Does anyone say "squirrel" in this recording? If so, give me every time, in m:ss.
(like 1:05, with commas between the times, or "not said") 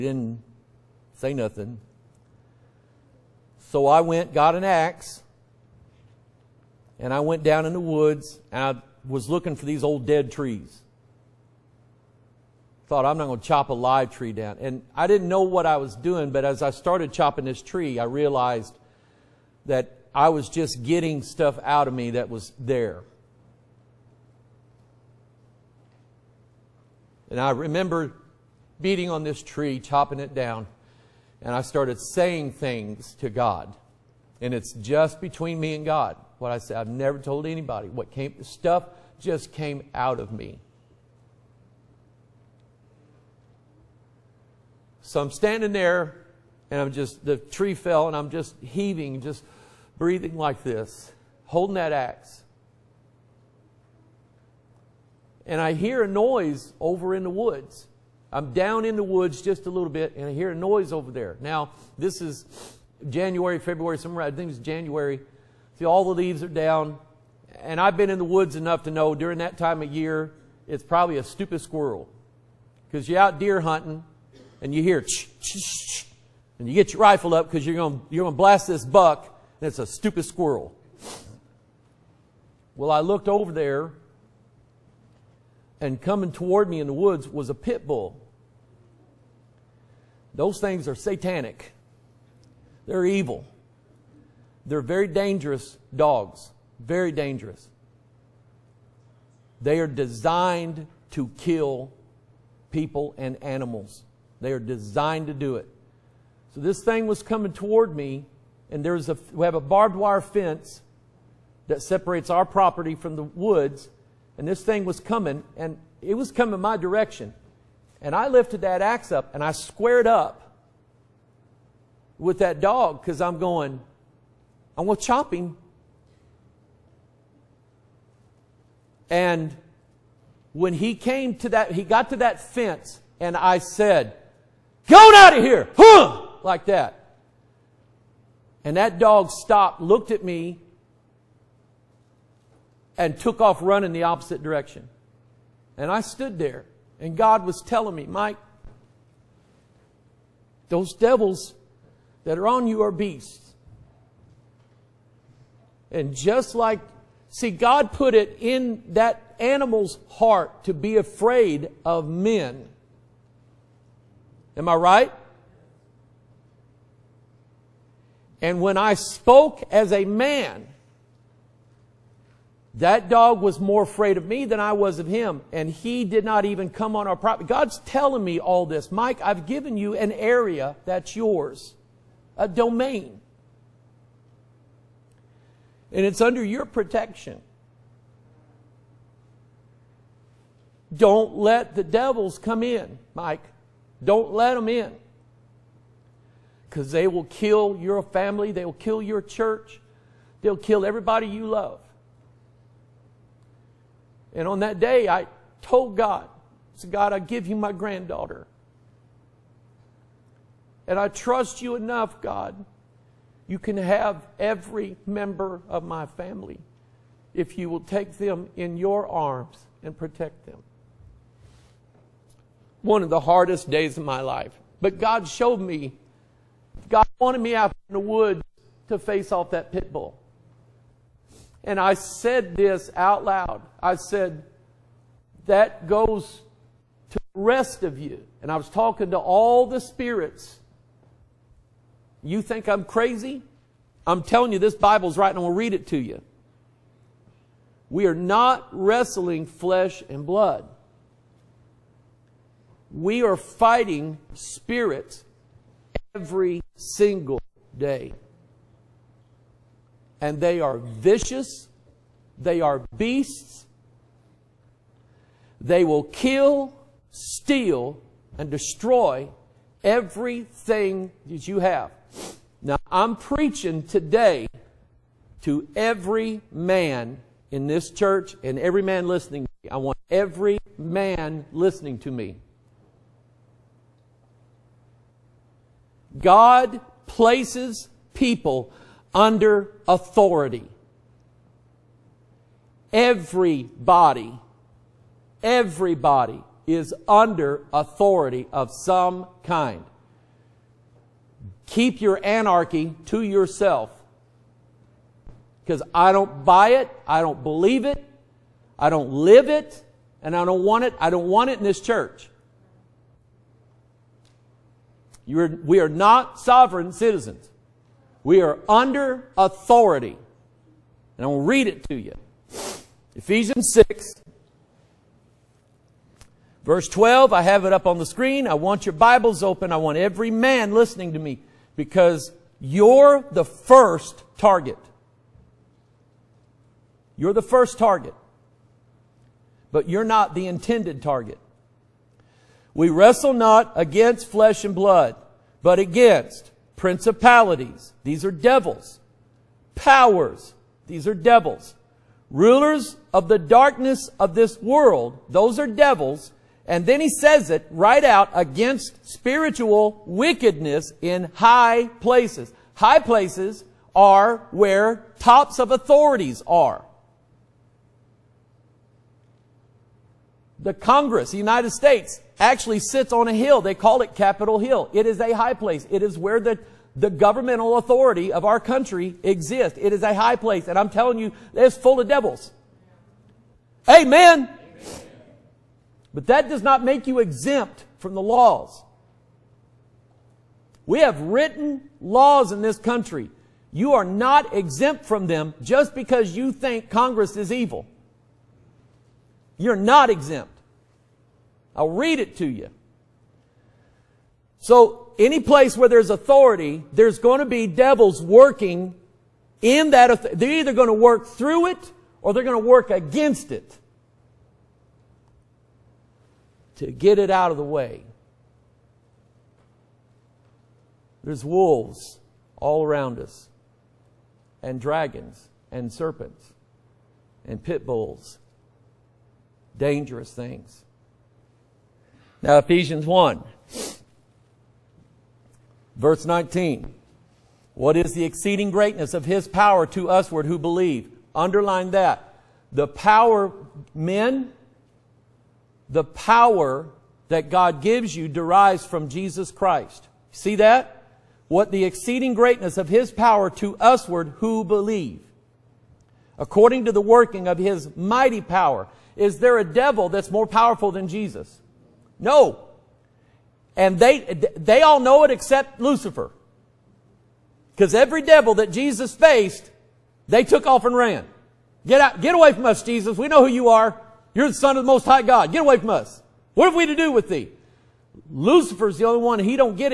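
1:11, 1:20.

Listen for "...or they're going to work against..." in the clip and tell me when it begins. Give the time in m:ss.
6:52.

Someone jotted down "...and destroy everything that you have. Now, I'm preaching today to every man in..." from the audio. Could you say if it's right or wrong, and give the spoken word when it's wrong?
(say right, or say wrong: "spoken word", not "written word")
right.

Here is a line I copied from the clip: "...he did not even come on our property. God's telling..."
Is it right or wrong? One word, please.
right.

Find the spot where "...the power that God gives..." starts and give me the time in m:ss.
7:25.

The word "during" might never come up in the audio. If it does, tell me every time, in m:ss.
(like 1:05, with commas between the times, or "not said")
1:09.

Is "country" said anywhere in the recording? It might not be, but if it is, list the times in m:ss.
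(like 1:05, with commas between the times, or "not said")
6:18, 6:32.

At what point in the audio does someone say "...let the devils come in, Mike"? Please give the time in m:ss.
3:11.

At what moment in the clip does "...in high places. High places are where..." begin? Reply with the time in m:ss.
6:00.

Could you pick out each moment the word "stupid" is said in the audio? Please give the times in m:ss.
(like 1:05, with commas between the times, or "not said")
1:11, 1:19.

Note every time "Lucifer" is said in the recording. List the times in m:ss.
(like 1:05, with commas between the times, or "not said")
7:45, 7:58.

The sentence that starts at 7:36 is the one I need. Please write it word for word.
According to the working of his mighty power.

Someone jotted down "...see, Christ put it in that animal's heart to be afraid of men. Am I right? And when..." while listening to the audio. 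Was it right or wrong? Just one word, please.
wrong.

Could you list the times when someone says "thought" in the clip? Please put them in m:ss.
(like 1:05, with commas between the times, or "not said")
0:12.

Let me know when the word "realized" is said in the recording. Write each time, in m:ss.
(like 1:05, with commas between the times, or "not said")
0:18.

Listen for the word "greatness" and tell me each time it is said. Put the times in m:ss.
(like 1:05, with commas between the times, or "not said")
7:18, 7:32.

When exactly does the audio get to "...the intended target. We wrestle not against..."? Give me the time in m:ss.
5:40.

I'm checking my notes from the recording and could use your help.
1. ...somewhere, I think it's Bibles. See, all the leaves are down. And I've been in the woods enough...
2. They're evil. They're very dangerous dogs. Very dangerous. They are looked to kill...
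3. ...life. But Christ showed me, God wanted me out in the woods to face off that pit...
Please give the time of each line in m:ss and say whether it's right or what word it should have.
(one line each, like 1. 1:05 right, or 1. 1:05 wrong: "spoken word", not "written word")
1. 1:03 wrong: "January", not "Bibles"
2. 1:32 wrong: "designed", not "looked"
3. 3:44 wrong: "God", not "Christ".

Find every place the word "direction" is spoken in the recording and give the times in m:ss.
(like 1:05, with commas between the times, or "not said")
1:56, 2:24.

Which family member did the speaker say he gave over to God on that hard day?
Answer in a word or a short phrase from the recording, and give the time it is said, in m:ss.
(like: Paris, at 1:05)
granddaughter, at 3:27.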